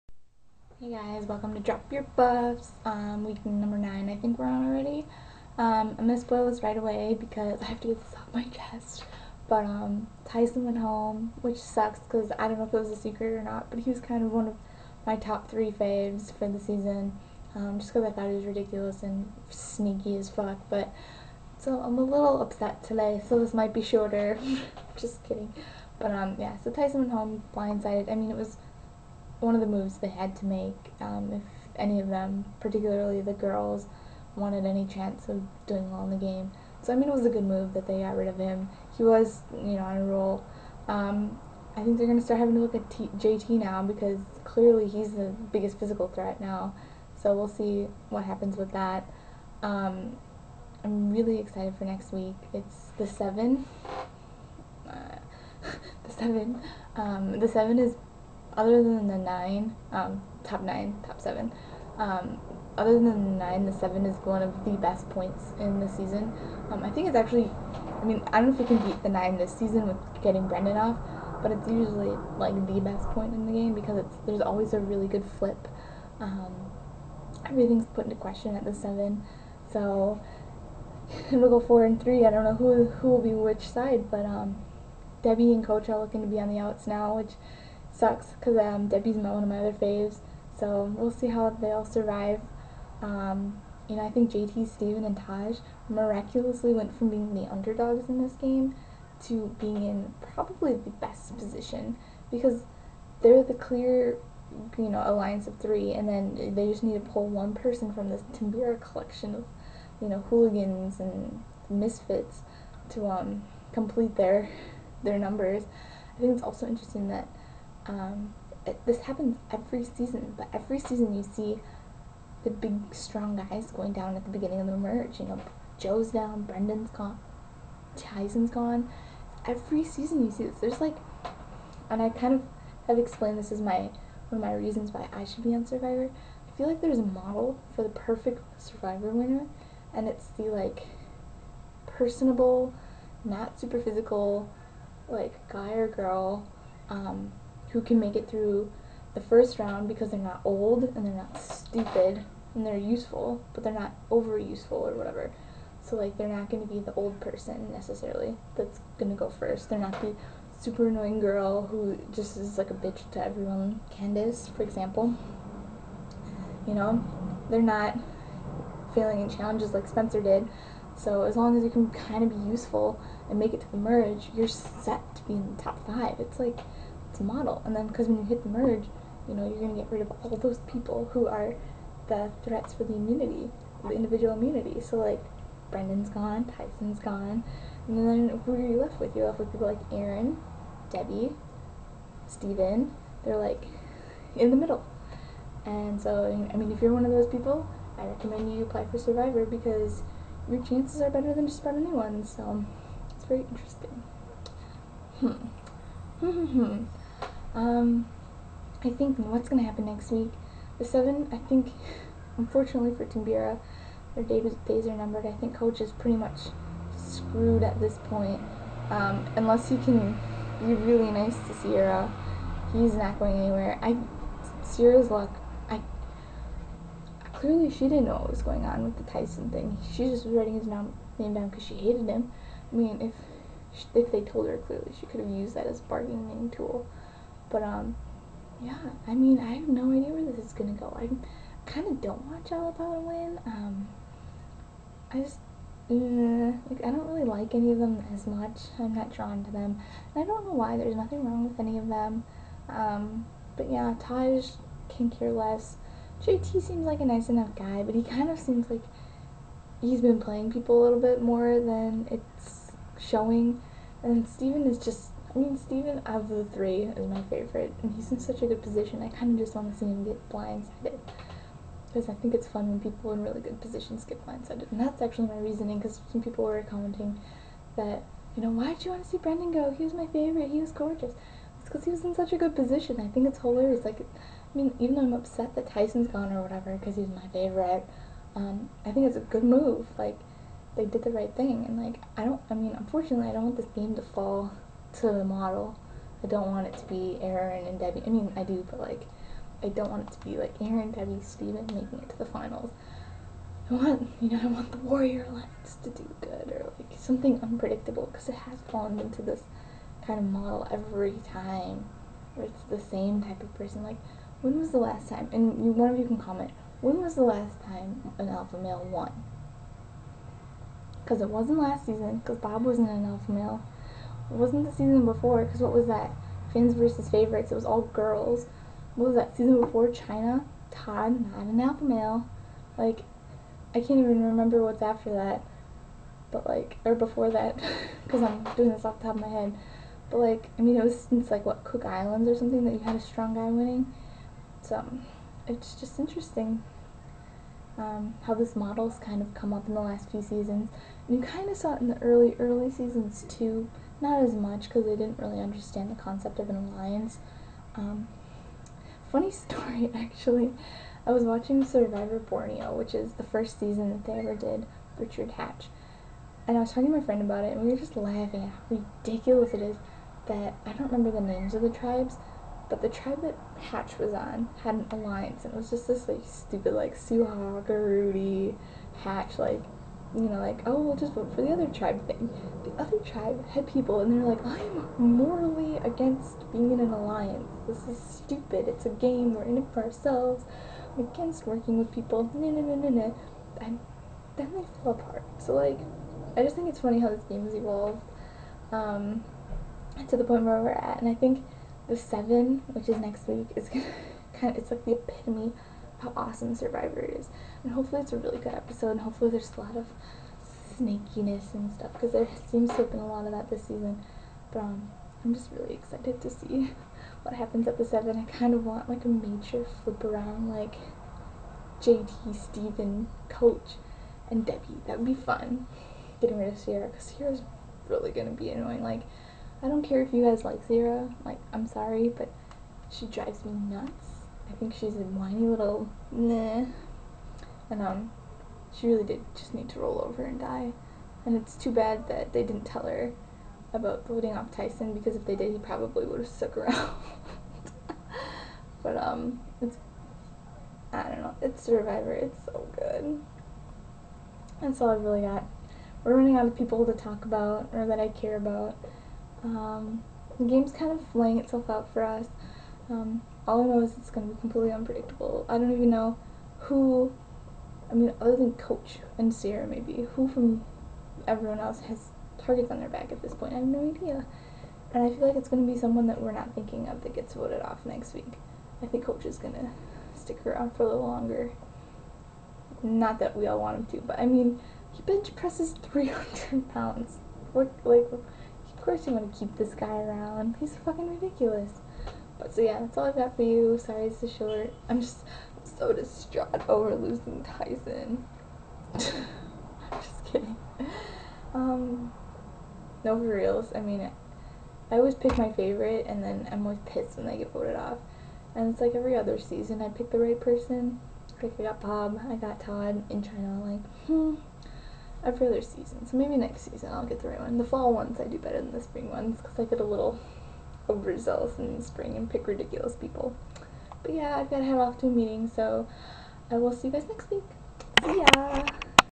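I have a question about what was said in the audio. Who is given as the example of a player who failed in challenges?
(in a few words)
Spencer.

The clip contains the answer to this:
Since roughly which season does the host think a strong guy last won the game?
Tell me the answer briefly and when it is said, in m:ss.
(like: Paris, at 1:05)
Cook Islands, at 5:41.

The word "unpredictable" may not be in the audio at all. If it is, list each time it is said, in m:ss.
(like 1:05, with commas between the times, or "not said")
5:07, 7:44.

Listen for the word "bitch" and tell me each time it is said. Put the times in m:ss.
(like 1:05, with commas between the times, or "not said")
2:42.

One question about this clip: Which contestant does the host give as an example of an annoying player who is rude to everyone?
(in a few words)
Candace.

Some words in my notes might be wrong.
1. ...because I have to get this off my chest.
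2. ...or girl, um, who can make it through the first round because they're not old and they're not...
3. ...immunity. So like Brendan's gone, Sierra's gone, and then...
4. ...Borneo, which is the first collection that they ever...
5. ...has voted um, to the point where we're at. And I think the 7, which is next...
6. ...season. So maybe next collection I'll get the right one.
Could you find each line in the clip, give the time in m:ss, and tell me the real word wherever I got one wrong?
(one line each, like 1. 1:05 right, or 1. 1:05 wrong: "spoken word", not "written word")
1. 0:07 right
2. 2:25 right
3. 3:04 wrong: "Tyson", not "Sierra"
4. 6:02 wrong: "season", not "collection"
5. 6:37 wrong: "evolved", not "voted"
6. 8:35 wrong: "season", not "collection".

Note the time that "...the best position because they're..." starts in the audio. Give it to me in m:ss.
1:40.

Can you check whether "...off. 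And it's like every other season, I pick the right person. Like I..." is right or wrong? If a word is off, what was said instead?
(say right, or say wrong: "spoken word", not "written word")
right.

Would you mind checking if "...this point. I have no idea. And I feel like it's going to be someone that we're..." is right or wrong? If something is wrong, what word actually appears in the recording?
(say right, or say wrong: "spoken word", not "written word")
right.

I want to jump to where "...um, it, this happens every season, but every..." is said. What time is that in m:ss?
1:57.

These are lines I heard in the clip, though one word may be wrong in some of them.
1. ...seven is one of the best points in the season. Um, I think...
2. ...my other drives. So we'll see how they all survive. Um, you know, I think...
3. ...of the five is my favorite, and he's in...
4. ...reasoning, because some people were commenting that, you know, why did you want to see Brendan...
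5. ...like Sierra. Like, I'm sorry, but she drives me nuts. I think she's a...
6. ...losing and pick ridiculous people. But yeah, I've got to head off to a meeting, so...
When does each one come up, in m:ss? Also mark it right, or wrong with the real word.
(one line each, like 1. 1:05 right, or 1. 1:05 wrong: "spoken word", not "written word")
1. 1:03 right
2. 1:29 wrong: "faves", not "drives"
3. 4:25 wrong: "three", not "five"
4. 4:35 right
5. 7:10 right
6. 8:41 wrong: "spring", not "losing".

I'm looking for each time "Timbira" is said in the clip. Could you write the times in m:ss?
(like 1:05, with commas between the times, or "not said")
1:48, 3:33.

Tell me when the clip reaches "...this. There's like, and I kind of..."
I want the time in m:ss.
2:10.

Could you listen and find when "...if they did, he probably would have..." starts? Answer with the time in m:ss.
7:25.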